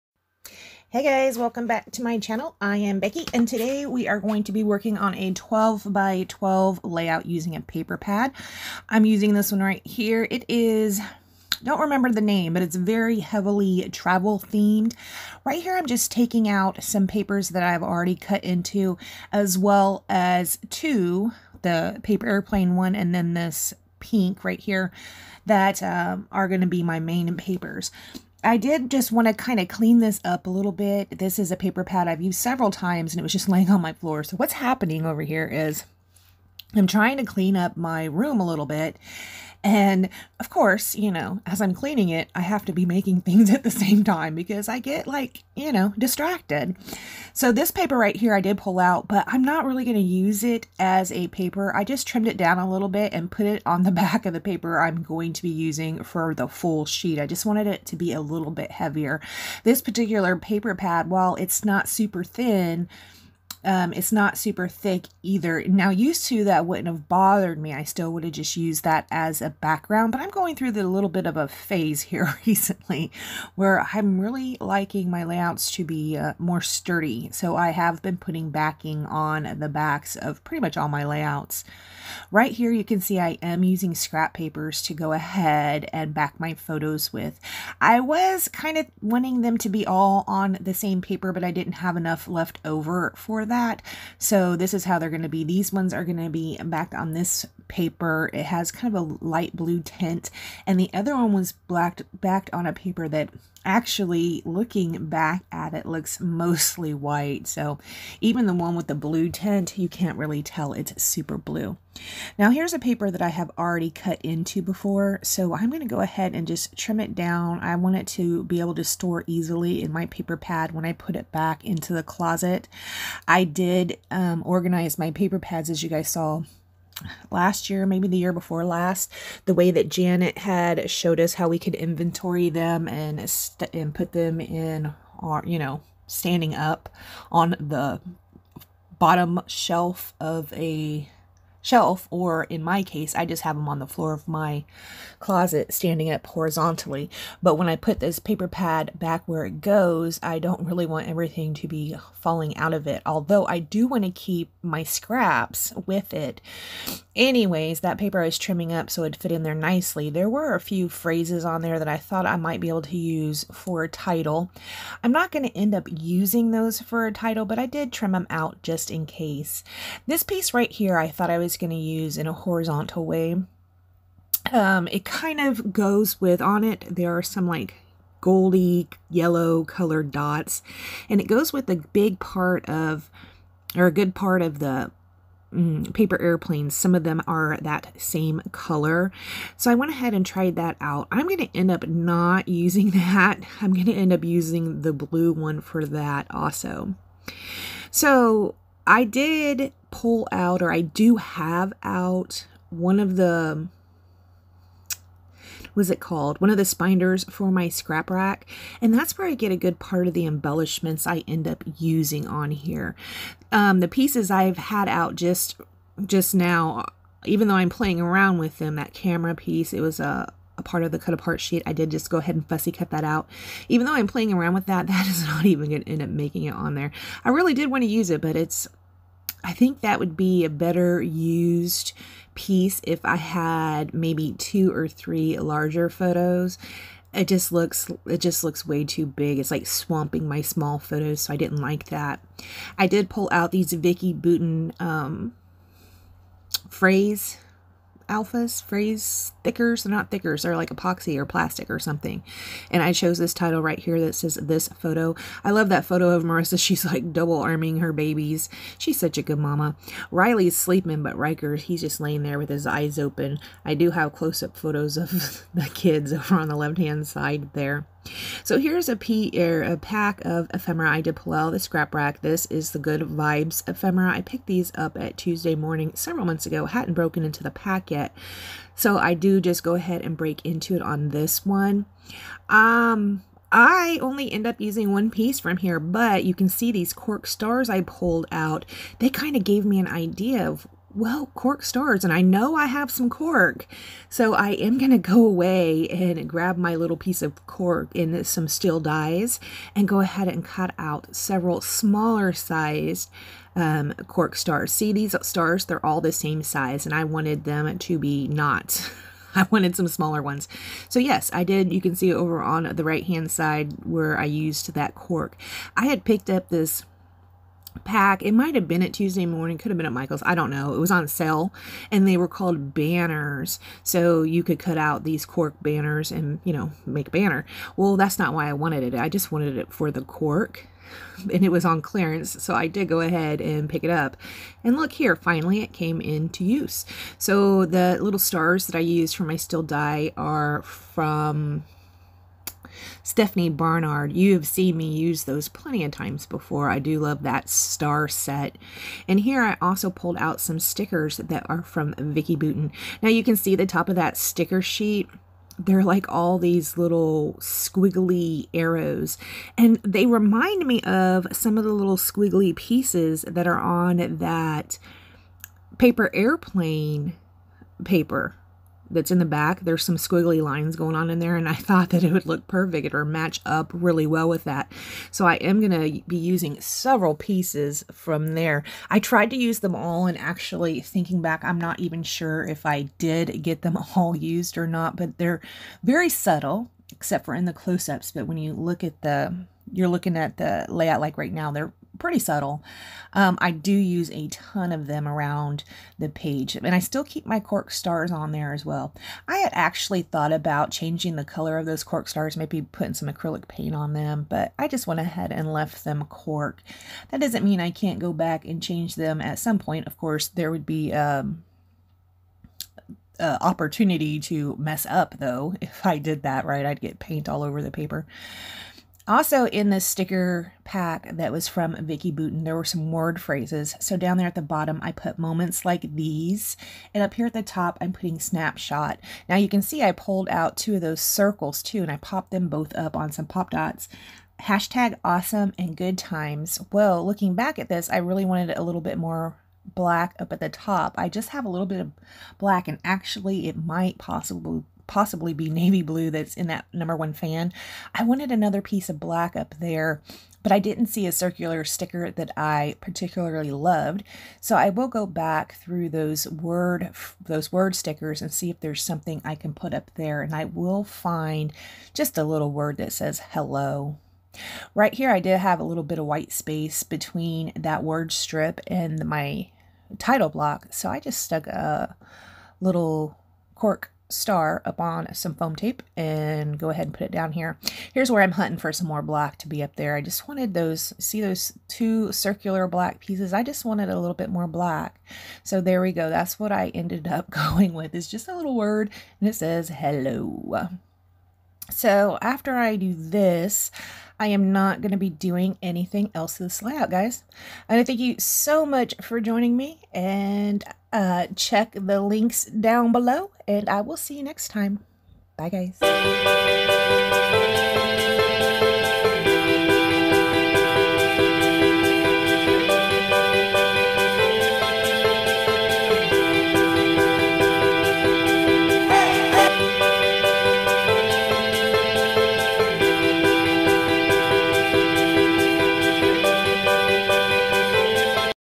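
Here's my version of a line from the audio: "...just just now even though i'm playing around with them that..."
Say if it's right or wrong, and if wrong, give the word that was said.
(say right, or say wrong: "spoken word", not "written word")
right.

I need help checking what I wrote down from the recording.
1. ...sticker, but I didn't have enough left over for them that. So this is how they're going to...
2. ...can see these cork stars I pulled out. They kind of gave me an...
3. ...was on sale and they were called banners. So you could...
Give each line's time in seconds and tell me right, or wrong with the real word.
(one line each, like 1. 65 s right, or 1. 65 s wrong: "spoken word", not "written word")
1. 91 s wrong: "paper", not "sticker"
2. 286 s right
3. 320 s right.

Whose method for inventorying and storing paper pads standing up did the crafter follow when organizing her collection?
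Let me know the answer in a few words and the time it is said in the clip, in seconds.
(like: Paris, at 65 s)
Janet, at 129 s.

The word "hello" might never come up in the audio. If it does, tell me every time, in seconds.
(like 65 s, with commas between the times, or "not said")
463 s, 489 s.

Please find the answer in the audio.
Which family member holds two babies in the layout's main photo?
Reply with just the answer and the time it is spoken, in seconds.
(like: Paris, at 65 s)
Marissa, at 256 s.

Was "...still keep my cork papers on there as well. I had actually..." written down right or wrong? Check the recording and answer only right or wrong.
wrong.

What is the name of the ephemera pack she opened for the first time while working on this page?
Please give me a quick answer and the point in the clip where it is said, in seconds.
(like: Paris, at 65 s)
Good Vibes, at 272 s.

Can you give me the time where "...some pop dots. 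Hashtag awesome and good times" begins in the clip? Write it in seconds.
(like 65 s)
433 s.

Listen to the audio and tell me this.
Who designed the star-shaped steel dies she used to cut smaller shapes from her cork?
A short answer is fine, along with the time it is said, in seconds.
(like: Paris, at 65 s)
Stephanie Barnard, at 343 s.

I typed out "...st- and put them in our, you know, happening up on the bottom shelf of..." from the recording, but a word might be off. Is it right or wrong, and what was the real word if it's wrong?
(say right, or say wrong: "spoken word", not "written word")
wrong: "standing", not "happening".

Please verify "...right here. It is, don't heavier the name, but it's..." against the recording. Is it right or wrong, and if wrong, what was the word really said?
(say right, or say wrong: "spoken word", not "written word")
wrong: "remember", not "heavier".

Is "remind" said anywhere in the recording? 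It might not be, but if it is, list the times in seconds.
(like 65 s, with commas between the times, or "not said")
360 s.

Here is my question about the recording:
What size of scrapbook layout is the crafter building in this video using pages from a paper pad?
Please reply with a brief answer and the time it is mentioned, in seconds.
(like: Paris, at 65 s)
12 by 12, at 5 s.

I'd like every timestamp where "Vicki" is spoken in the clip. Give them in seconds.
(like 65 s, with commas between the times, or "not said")
243 s, 351 s, 421 s.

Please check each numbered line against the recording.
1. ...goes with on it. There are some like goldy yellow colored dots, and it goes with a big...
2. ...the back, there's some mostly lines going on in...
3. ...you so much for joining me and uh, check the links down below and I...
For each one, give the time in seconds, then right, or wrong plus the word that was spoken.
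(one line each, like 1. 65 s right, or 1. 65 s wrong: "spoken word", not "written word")
1. 175 s right
2. 369 s wrong: "squiggly", not "mostly"
3. 497 s right.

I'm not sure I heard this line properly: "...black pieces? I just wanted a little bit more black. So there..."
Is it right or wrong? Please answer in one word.
right.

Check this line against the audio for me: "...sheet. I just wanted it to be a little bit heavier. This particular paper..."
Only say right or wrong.
right.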